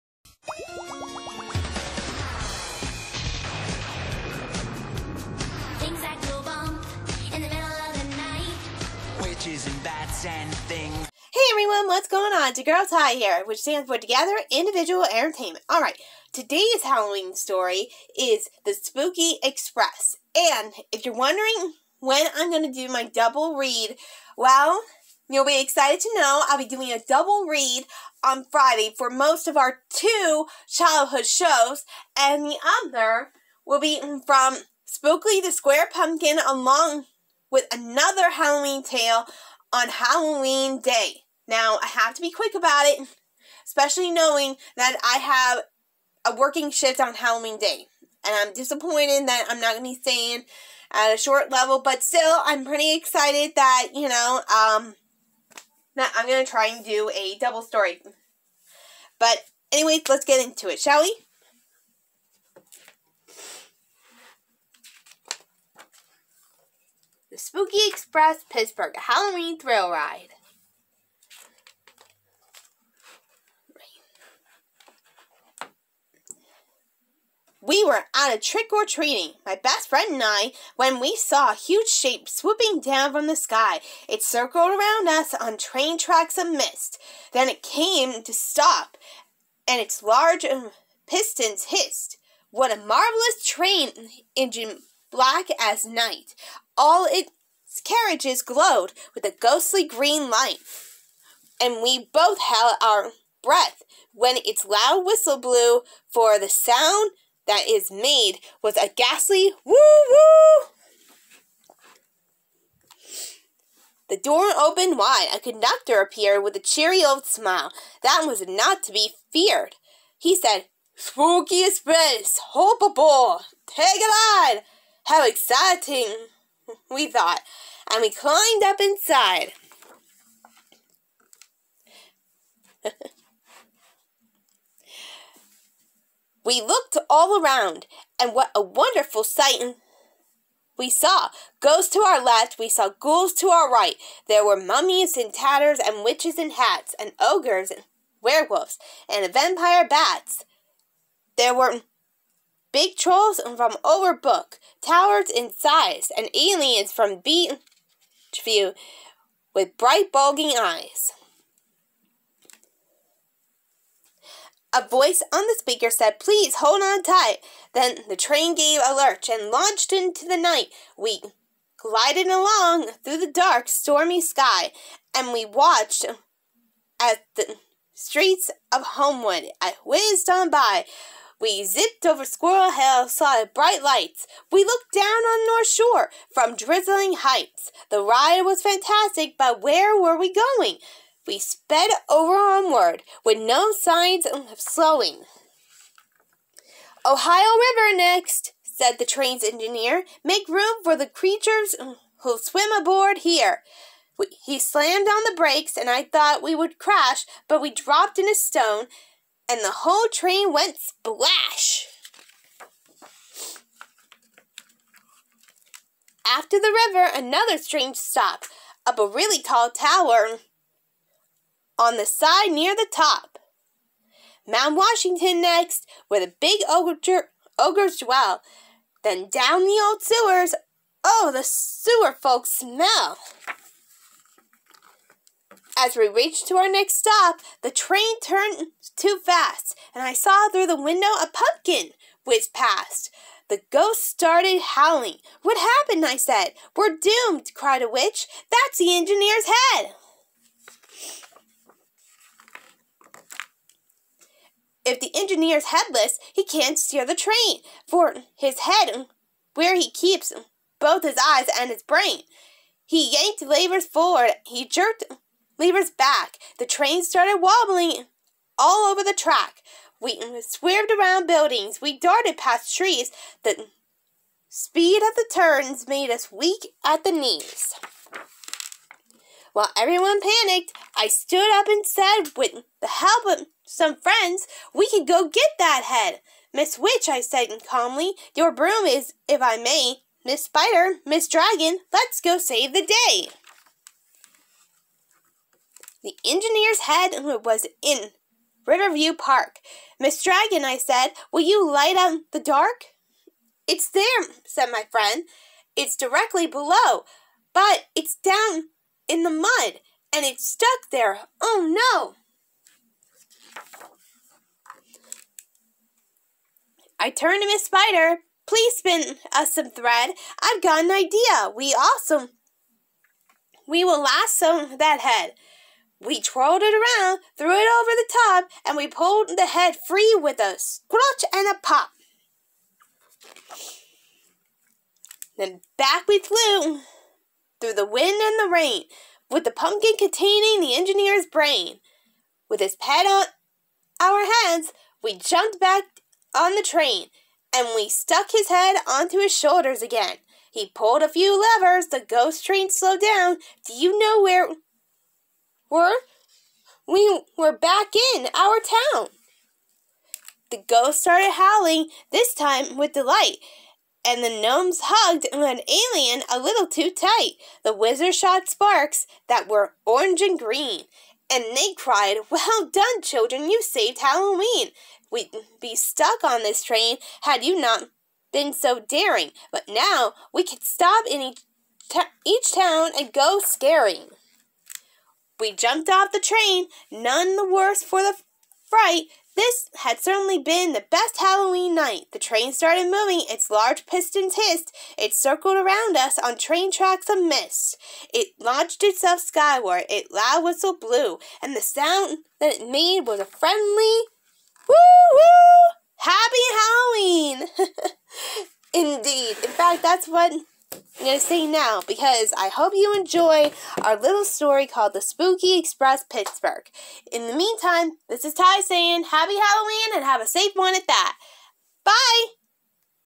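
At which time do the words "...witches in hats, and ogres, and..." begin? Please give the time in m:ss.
2:26.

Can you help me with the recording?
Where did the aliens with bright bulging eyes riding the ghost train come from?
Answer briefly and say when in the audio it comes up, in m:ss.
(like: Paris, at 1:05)
Beach View, at 2:37.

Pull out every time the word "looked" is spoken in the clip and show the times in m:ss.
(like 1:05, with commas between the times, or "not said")
2:16, 3:04.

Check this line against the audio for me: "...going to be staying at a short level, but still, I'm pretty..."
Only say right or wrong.
right.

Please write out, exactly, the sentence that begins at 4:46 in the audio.
Miss Witch, I said calmly, your broom is, if I may, Miss Spider, Miss Dragon, let's go save the day.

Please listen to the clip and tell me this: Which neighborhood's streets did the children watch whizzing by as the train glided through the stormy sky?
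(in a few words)
Homewood.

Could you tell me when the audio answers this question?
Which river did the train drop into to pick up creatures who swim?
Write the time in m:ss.
3:17.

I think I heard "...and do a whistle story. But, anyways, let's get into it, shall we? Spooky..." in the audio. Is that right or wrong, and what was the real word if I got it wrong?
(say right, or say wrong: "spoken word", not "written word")
wrong: "double", not "whistle".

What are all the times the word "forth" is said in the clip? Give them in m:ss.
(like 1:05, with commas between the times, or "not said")
not said.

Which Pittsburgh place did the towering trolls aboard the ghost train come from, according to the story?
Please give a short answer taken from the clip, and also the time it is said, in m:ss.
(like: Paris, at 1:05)
Overbrook, at 2:33.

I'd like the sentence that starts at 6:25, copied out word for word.
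We jumped off the train, none the worse for the fright.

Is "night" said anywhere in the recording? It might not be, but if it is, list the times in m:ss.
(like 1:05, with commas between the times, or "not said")
1:35, 2:50, 6:31.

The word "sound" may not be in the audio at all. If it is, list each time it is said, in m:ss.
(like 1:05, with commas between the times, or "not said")
1:46, 6:41.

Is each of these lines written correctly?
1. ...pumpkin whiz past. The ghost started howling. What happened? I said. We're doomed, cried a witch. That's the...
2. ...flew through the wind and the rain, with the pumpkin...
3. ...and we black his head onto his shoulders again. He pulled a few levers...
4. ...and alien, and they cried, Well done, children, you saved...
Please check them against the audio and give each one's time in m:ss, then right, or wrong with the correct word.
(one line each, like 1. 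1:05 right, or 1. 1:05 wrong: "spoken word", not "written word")
1. 4:01 right
2. 5:36 right
3. 5:47 wrong: "stuck", not "black"
4. 6:10 wrong: "green", not "alien".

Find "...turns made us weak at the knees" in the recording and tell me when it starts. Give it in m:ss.
4:35.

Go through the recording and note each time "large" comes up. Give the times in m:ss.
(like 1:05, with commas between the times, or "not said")
1:30, 6:33.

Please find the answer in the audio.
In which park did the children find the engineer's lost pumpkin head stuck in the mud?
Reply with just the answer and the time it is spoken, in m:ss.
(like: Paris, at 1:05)
Riverview Park, at 4:58.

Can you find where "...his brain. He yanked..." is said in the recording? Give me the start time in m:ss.
4:21.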